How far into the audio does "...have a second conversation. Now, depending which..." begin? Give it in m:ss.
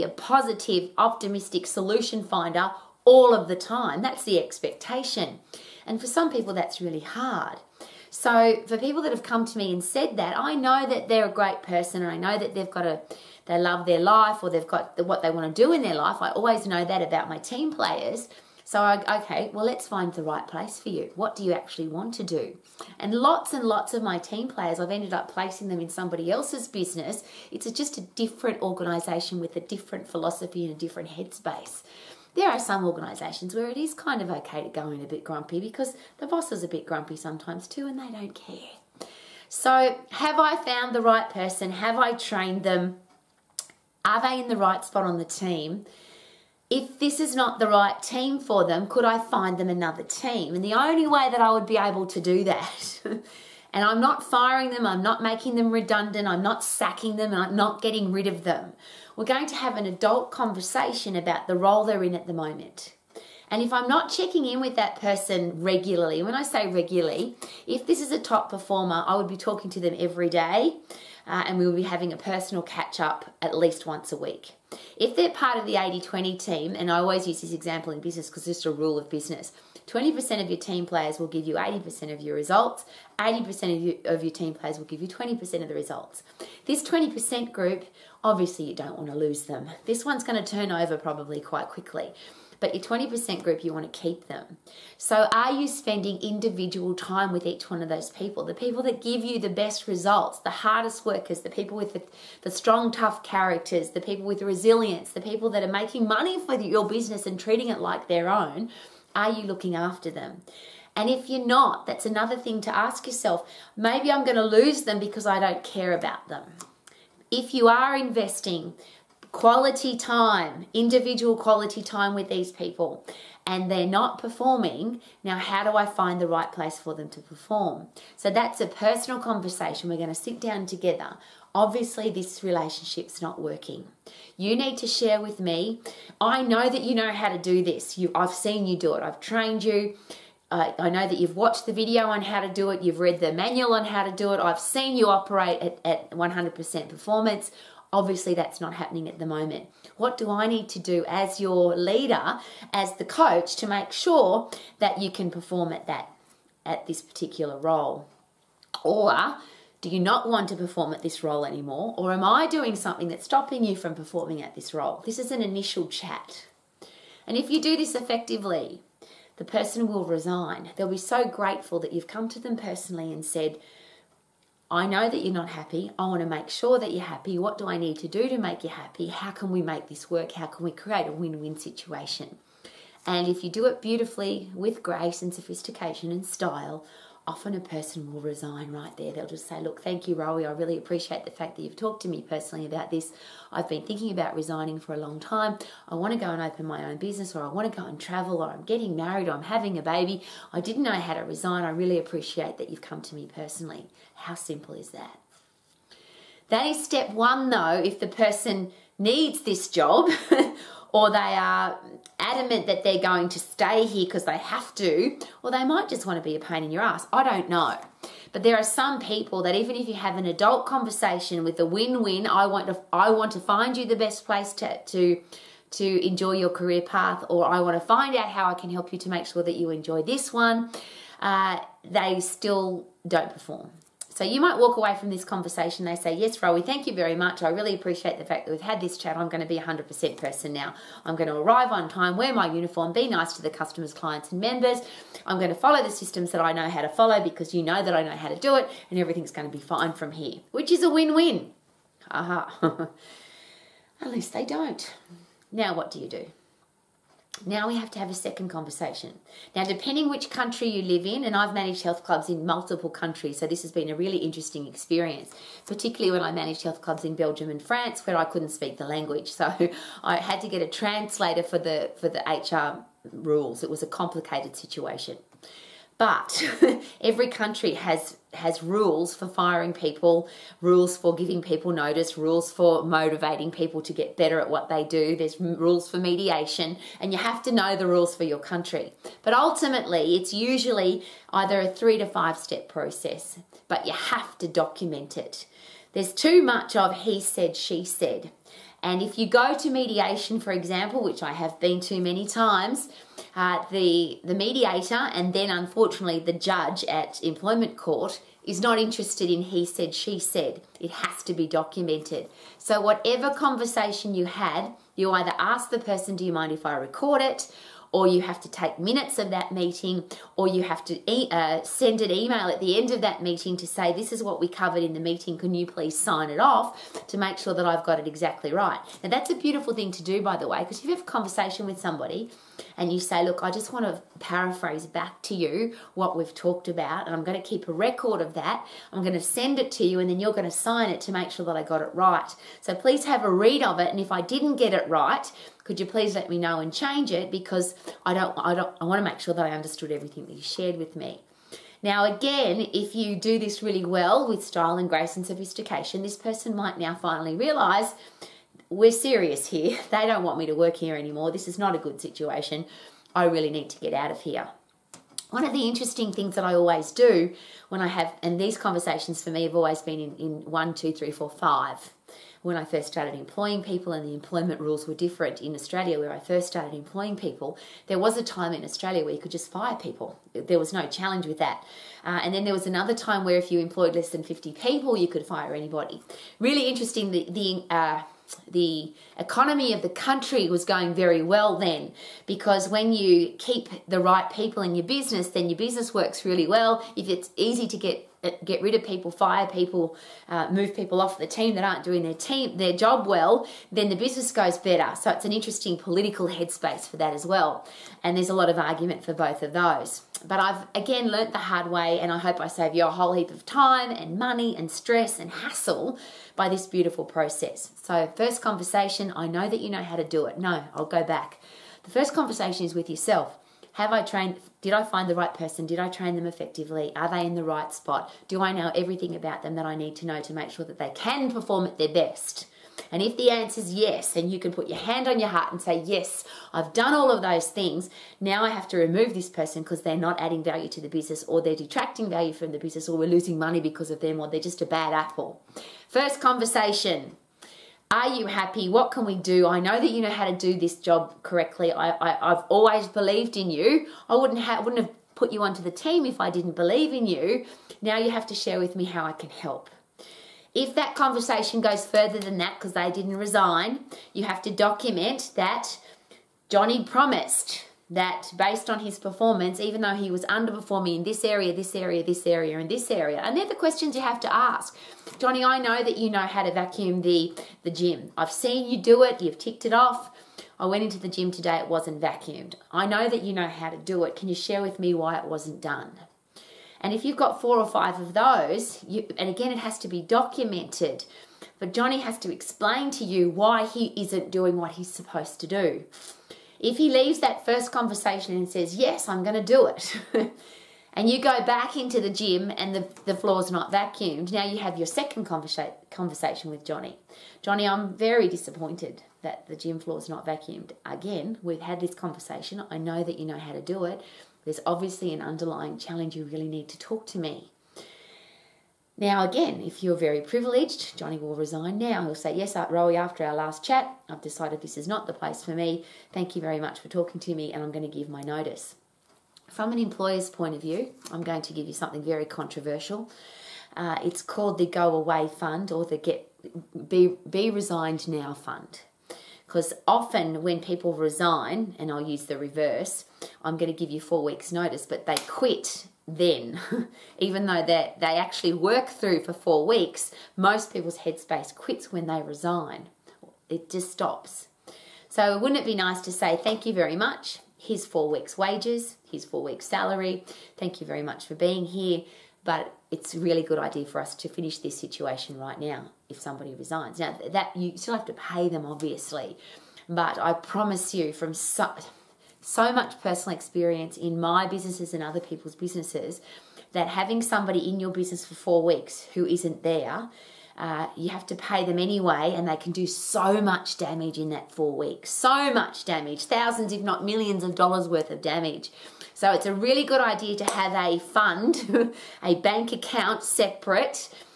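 4:17.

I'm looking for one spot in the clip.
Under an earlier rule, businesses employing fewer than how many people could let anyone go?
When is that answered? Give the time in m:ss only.
6:24.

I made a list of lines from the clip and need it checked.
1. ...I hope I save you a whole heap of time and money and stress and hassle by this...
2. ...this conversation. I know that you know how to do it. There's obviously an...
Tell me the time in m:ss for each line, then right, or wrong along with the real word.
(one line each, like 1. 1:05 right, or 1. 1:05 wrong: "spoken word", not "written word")
1. 6:52 right
2. 8:31 right.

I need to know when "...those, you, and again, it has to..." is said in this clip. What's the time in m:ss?
8:08.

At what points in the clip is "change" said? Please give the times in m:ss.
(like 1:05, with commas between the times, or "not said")
5:46.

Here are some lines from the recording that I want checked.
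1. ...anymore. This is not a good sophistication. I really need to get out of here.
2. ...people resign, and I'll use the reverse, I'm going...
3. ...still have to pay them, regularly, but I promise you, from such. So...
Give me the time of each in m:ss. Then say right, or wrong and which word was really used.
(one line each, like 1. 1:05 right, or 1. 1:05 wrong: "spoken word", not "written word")
1. 6:00 wrong: "situation", not "sophistication"
2. 9:00 right
3. 9:27 wrong: "obviously", not "regularly".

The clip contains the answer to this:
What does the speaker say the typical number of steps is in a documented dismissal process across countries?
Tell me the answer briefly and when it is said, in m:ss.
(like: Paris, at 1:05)
3 to 5, at 4:51.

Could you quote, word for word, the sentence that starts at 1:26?
This 20% group Obviously, you don't want to lose them.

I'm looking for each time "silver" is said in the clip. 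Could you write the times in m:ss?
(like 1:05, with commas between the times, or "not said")
not said.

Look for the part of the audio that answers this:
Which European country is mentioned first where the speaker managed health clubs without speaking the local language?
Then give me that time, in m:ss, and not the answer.
4:27.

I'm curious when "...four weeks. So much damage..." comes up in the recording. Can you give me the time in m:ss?
9:44.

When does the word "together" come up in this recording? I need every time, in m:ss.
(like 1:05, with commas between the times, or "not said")
2:10.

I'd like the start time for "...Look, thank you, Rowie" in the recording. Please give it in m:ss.
3:09.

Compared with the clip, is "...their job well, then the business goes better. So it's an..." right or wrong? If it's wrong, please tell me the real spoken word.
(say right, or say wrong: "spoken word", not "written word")
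right.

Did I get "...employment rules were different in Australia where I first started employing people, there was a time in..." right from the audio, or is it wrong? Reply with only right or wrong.
right.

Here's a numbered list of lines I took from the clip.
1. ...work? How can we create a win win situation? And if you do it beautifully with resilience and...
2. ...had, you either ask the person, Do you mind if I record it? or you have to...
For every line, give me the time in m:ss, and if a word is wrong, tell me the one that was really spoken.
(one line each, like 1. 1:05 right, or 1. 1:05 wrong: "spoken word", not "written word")
1. 3:00 wrong: "grace", not "resilience"
2. 5:14 right.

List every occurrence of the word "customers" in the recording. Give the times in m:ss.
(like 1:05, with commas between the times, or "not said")
4:03.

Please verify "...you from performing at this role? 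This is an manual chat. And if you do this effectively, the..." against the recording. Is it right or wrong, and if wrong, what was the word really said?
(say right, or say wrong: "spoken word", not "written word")
wrong: "initial", not "manual".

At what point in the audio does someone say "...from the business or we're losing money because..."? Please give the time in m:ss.
7:22.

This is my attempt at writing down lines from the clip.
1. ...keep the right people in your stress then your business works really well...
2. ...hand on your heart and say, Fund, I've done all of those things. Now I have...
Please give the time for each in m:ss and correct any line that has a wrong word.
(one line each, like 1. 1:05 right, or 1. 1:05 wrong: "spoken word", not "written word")
1. 6:33 wrong: "business", not "stress"
2. 7:14 wrong: "Yes", not "Fund".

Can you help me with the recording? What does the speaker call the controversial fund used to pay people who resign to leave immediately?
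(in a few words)
Go Away Fund.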